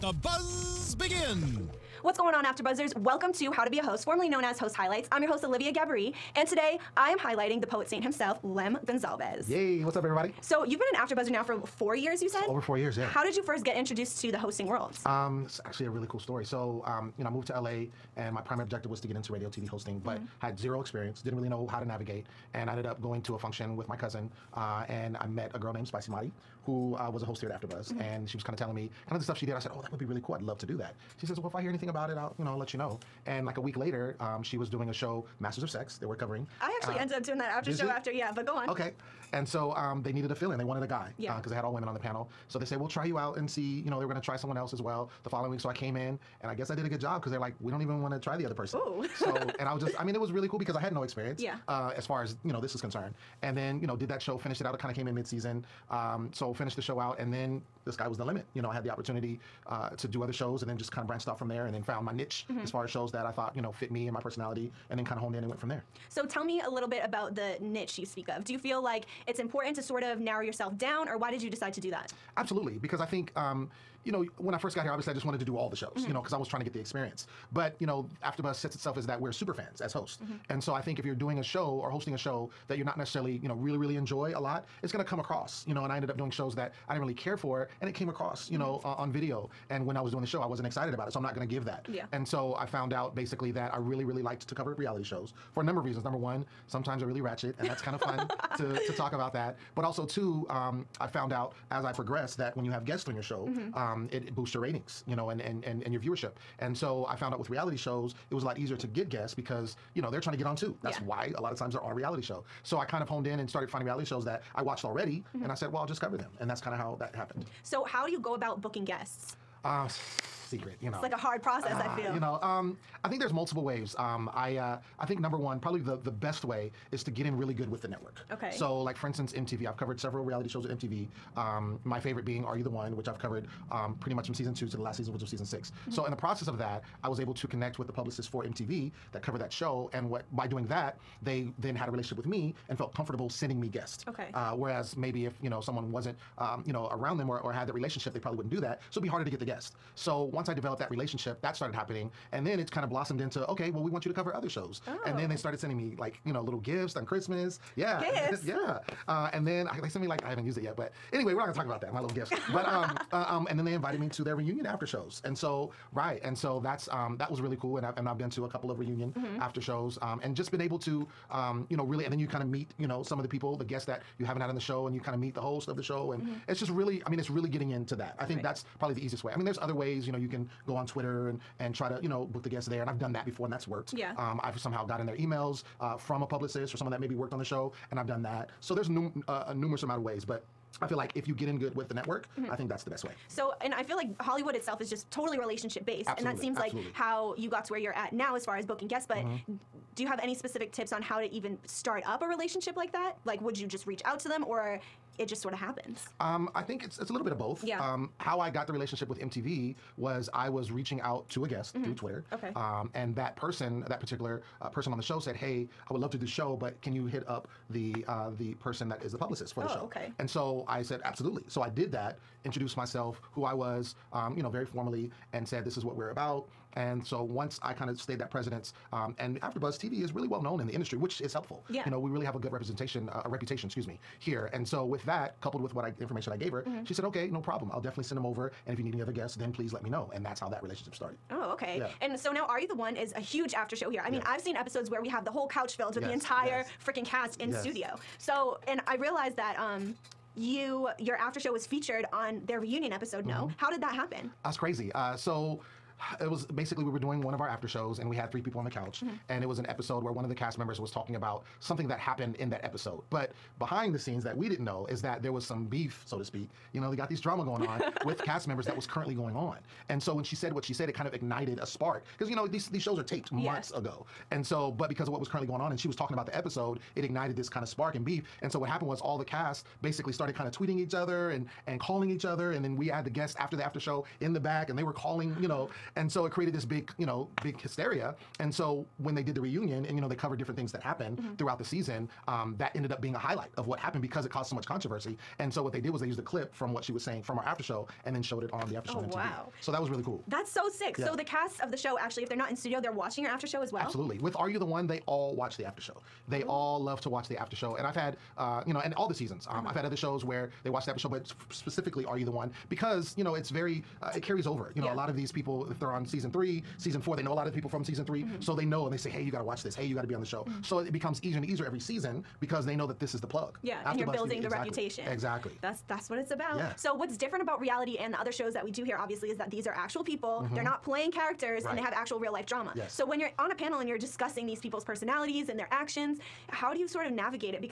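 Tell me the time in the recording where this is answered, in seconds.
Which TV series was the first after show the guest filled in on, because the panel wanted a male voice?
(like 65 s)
35 s.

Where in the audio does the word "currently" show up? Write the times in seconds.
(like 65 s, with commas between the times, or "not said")
268 s, 275 s.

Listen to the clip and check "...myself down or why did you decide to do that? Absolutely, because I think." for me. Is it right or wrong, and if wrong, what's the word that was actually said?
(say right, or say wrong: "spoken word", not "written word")
wrong: "yourself", not "myself".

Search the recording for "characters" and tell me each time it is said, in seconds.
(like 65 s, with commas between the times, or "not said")
331 s.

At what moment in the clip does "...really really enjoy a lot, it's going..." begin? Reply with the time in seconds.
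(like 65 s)
83 s.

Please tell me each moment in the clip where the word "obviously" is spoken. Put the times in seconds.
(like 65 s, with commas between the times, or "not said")
74 s, 328 s.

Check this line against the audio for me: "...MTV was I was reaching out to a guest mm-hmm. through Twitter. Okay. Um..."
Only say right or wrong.
right.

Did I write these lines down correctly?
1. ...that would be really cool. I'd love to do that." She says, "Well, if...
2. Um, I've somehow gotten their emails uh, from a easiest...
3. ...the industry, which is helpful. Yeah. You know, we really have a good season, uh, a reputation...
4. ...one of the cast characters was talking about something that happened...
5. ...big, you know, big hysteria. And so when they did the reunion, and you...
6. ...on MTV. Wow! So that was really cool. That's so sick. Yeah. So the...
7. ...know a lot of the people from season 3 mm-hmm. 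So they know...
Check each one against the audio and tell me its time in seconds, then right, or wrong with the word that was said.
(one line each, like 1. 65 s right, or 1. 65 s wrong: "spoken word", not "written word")
1. 29 s right
2. 184 s wrong: "publicist", not "easiest"
3. 230 s wrong: "representation", not "season"
4. 260 s wrong: "members", not "characters"
5. 286 s right
6. 298 s right
7. 317 s right.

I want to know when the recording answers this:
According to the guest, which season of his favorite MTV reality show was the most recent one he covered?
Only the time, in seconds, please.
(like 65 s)
135 s.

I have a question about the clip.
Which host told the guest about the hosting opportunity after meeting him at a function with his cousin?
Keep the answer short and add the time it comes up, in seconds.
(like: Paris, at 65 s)
Spicy Madi, at 25 s.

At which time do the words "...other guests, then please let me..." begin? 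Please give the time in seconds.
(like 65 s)
239 s.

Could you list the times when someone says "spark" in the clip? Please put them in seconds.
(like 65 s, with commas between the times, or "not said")
271 s, 277 s.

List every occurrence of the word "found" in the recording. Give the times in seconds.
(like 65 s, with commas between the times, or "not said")
61 s, 92 s, 101 s, 107 s.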